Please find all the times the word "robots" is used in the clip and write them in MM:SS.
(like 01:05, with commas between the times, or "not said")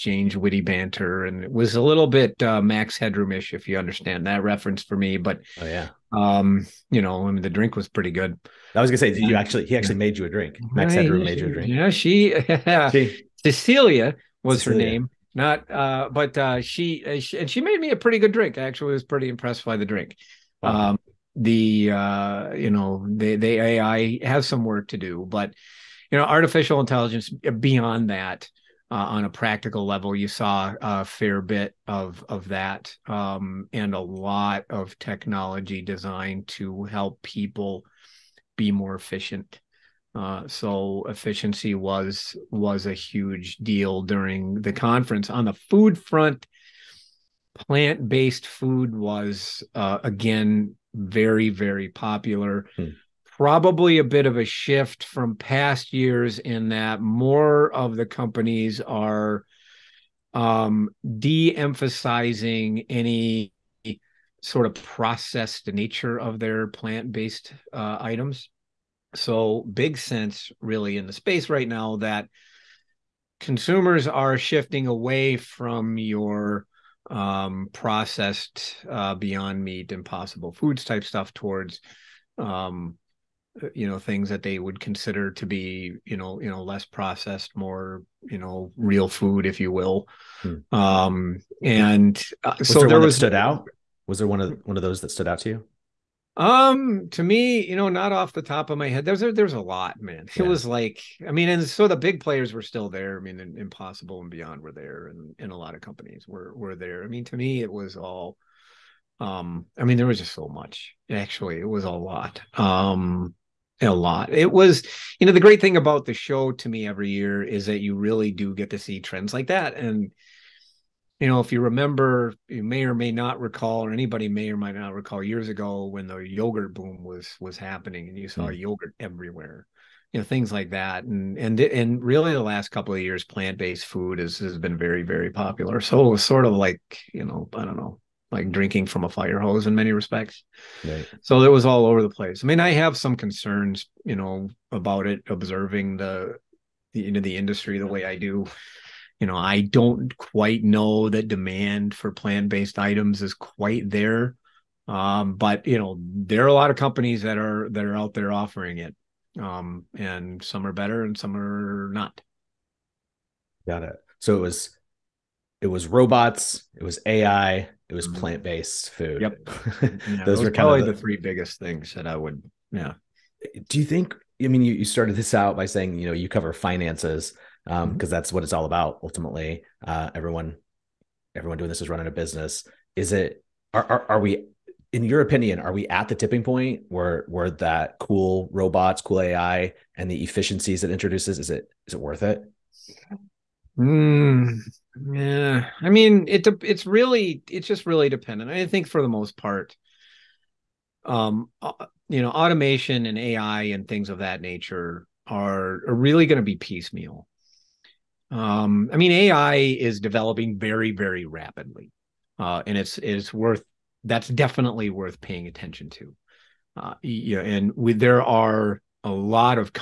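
02:45, 03:08.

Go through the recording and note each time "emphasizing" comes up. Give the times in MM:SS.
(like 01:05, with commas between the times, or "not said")
01:01.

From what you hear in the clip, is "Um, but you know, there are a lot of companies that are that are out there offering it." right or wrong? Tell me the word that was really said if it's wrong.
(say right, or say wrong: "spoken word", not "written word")
right.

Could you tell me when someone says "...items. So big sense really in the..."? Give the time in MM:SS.
01:07.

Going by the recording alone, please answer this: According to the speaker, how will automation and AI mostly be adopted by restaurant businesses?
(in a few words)
piecemeal.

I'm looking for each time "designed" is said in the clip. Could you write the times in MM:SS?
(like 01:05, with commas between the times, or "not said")
00:35.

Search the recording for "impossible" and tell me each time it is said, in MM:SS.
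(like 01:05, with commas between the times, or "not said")
01:19, 01:43.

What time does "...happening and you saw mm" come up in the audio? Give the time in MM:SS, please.
02:07.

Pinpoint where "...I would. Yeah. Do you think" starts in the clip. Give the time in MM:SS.
02:52.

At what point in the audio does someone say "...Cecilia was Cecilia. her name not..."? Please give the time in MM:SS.
00:13.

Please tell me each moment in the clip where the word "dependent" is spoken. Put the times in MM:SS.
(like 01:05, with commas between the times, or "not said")
03:18.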